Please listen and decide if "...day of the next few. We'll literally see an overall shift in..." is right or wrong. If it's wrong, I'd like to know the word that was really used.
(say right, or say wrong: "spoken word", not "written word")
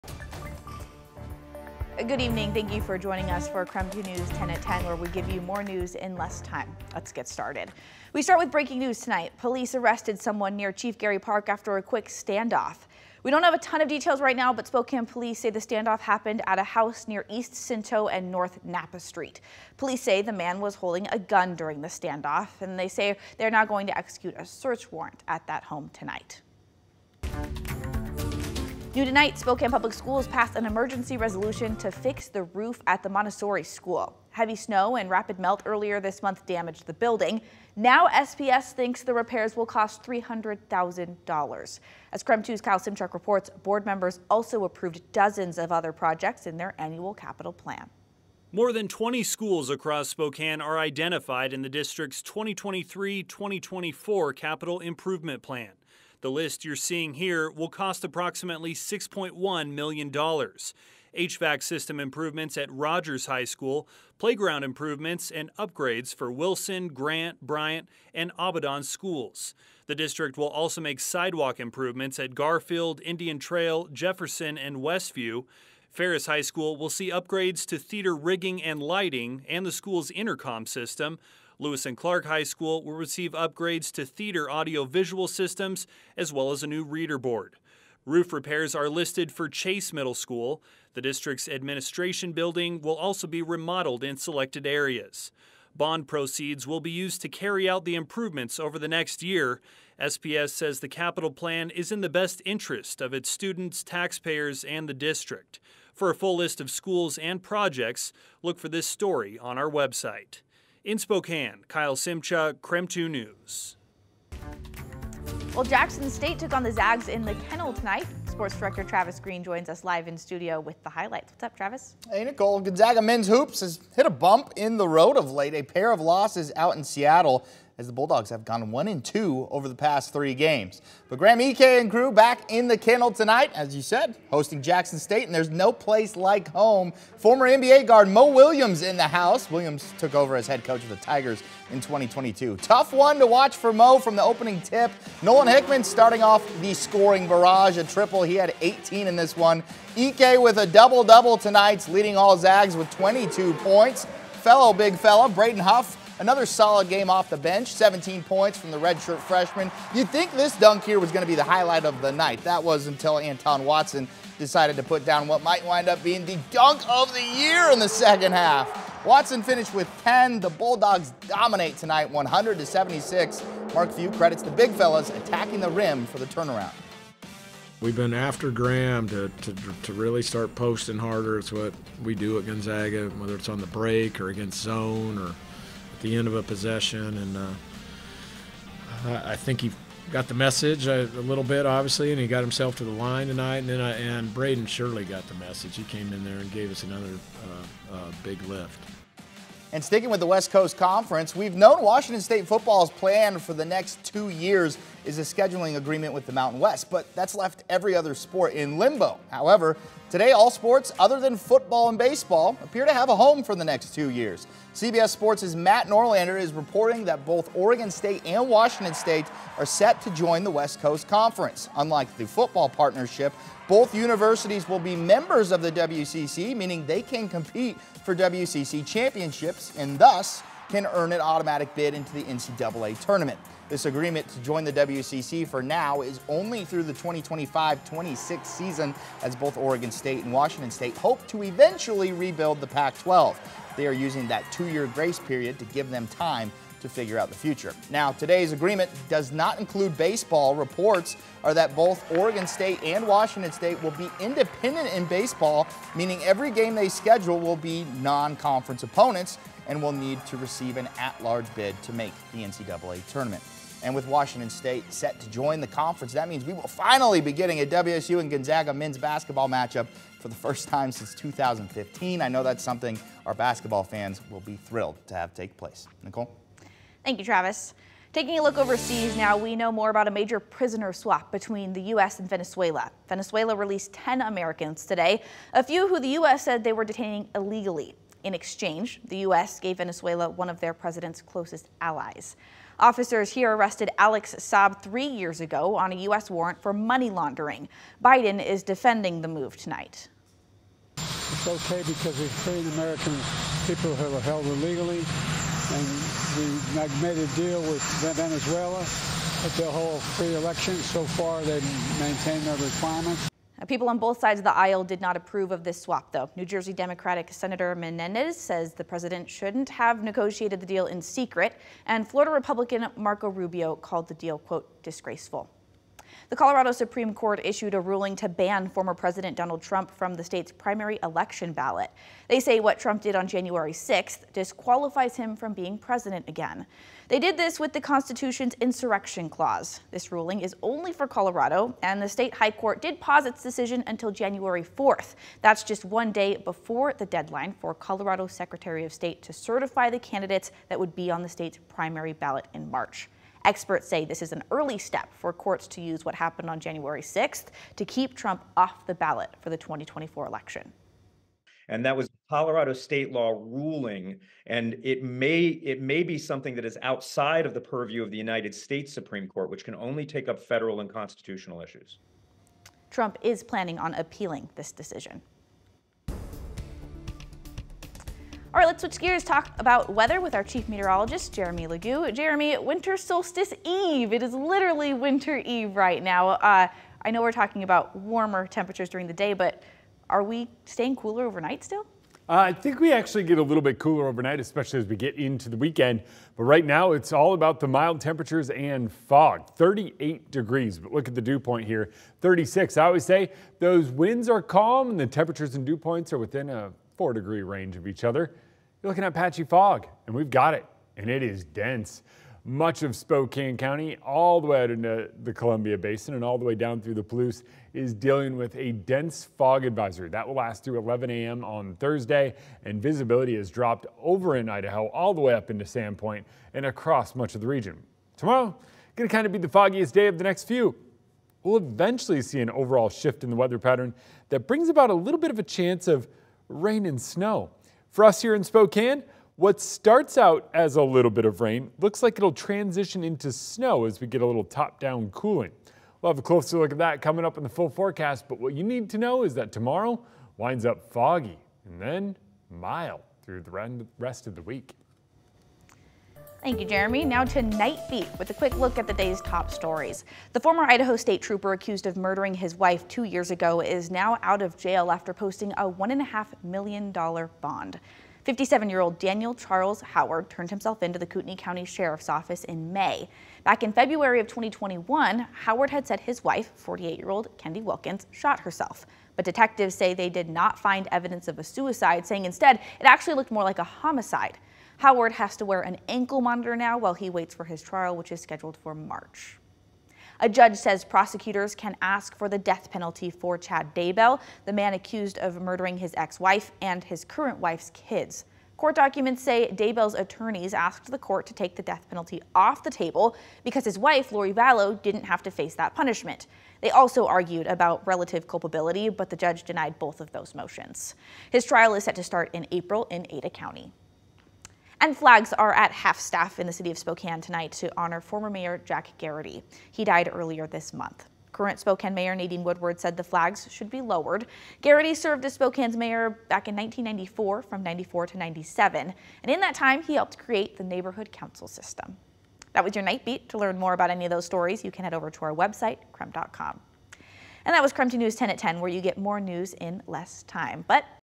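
wrong: "eventually", not "literally".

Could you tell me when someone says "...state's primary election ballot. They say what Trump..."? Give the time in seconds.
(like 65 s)
330 s.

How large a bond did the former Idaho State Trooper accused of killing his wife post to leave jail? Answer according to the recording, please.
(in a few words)
$1.5 million.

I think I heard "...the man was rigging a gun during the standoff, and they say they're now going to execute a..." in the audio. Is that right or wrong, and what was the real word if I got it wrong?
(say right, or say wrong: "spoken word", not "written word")
wrong: "holding", not "rigging".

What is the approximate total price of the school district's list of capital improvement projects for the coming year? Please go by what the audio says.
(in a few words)
$6.1 million.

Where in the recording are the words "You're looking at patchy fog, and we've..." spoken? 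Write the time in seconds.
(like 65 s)
408 s.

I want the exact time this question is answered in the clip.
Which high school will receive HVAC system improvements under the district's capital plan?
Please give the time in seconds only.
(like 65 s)
62 s.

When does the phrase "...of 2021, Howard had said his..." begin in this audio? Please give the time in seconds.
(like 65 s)
474 s.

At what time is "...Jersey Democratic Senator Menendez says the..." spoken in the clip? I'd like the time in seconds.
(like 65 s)
316 s.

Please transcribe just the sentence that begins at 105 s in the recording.
For a full list of schools and projects, look for this story on our website.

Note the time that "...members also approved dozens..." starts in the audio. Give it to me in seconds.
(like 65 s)
43 s.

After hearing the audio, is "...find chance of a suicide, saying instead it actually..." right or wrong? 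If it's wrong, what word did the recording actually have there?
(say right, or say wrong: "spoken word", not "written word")
wrong: "evidence", not "chance".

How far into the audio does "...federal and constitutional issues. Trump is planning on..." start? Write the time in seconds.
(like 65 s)
370 s.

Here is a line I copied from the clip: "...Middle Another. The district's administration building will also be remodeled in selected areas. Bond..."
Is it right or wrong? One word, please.
wrong.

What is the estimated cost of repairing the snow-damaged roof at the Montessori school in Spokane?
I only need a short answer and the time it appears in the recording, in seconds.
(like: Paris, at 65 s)
$300,000, at 40 s.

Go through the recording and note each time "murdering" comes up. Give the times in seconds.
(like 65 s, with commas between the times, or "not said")
461 s, 495 s.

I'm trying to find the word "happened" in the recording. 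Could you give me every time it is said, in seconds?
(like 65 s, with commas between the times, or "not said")
15 s, 356 s.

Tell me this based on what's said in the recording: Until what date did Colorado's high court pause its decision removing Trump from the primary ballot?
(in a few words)
January 4th.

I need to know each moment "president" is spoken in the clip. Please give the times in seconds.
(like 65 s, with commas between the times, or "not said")
290 s, 318 s, 328 s, 335 s.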